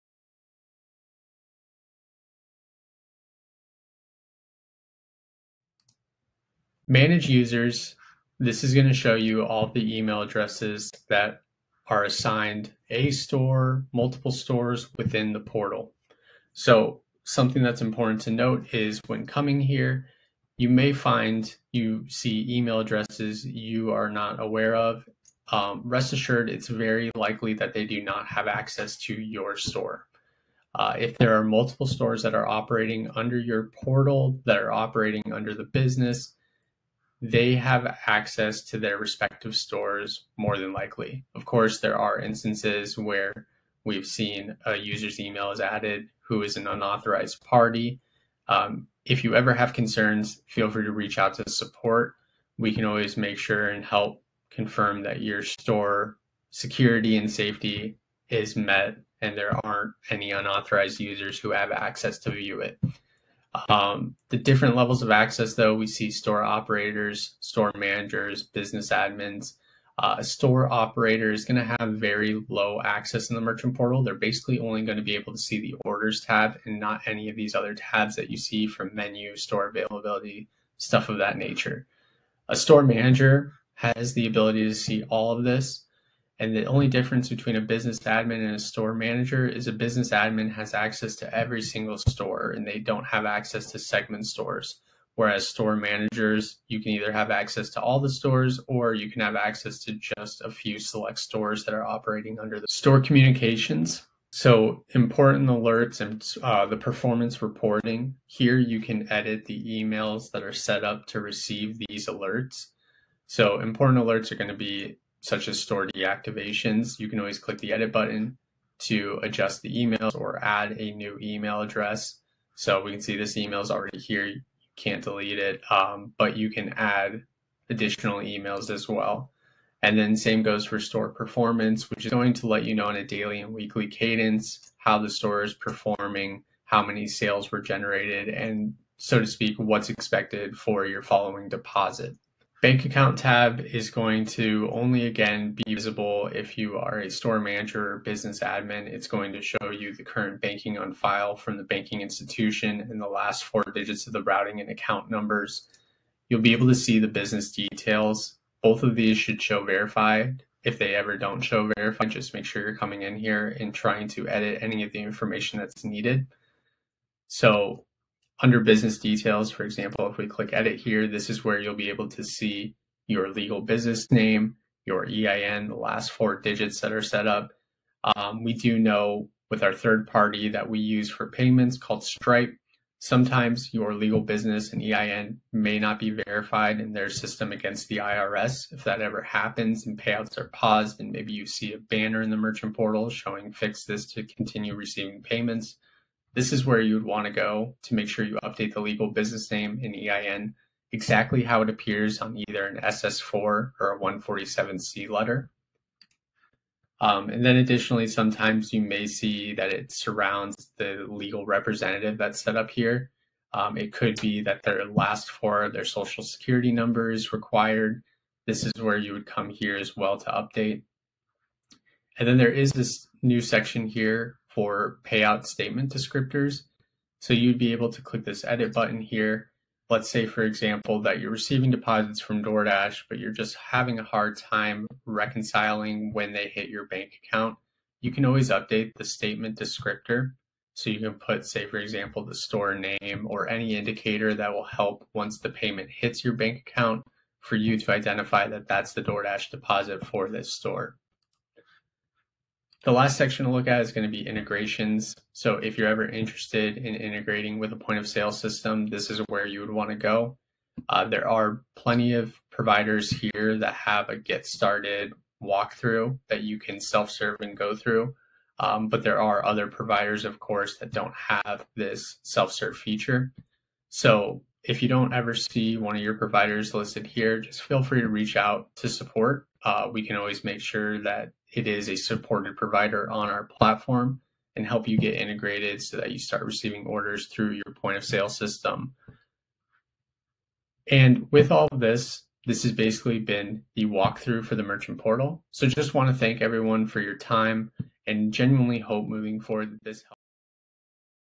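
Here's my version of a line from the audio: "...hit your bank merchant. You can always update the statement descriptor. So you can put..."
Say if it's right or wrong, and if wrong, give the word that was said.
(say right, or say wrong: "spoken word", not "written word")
wrong: "account", not "merchant".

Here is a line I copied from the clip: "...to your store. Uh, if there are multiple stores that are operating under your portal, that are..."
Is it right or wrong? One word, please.
right.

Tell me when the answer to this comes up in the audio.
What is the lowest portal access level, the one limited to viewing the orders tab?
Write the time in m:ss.
1:10.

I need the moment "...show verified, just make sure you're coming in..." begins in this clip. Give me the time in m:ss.
2:41.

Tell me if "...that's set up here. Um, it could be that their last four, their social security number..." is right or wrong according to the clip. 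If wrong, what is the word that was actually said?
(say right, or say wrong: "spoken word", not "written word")
right.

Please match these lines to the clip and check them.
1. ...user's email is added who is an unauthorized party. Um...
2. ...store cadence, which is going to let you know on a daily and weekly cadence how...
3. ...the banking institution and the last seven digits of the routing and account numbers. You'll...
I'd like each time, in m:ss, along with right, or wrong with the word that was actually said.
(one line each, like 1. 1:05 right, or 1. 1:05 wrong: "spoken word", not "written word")
1. 0:44 right
2. 2:10 wrong: "performance", not "cadence"
3. 2:31 wrong: "four", not "seven".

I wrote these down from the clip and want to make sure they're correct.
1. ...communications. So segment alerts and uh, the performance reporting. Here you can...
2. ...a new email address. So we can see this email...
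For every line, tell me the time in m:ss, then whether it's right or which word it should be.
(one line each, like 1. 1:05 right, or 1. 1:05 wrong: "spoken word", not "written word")
1. 1:43 wrong: "important", not "segment"
2. 2:00 right.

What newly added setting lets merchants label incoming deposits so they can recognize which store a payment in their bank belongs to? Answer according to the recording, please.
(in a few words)
Payout statement descriptors.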